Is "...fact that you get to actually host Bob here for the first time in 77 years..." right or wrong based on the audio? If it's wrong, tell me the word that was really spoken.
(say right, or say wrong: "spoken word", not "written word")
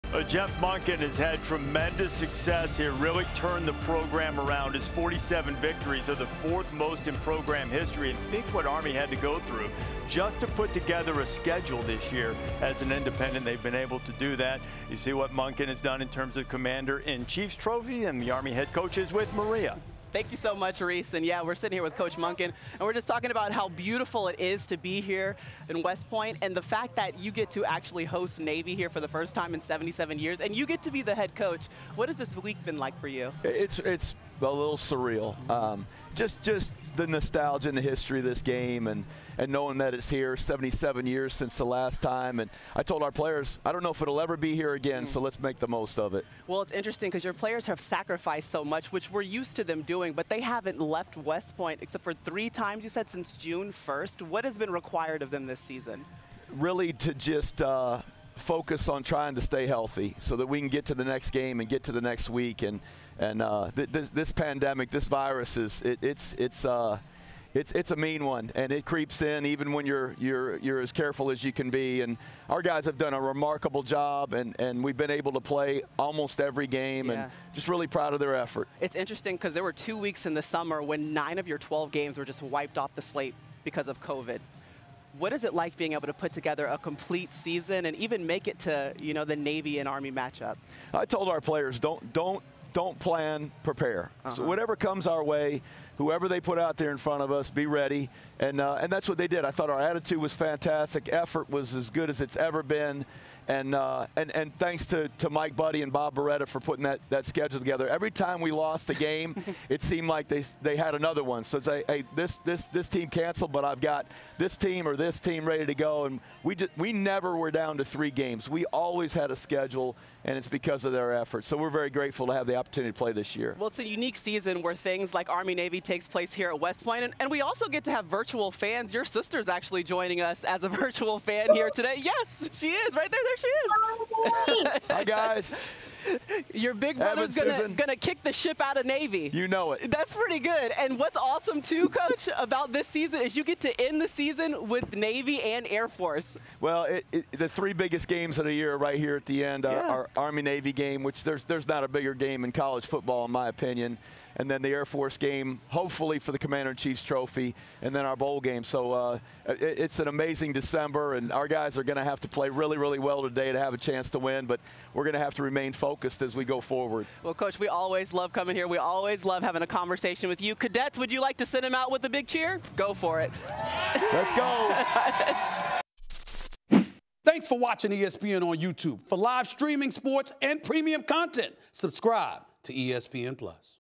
wrong: "Navy", not "Bob".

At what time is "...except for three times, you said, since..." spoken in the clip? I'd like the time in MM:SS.
00:51.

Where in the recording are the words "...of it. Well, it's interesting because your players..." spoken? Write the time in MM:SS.
00:45.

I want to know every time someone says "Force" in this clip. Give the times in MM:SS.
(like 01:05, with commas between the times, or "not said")
02:25, 02:34.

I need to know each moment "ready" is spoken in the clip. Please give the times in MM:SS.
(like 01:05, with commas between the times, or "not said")
01:37, 01:55.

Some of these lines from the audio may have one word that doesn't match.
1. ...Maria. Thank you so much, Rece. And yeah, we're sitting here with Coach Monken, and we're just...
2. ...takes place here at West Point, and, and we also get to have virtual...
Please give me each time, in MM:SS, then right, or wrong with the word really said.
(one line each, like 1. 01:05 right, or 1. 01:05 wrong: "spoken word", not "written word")
1. 00:19 right
2. 02:05 right.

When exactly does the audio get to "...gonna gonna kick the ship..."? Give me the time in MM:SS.
02:17.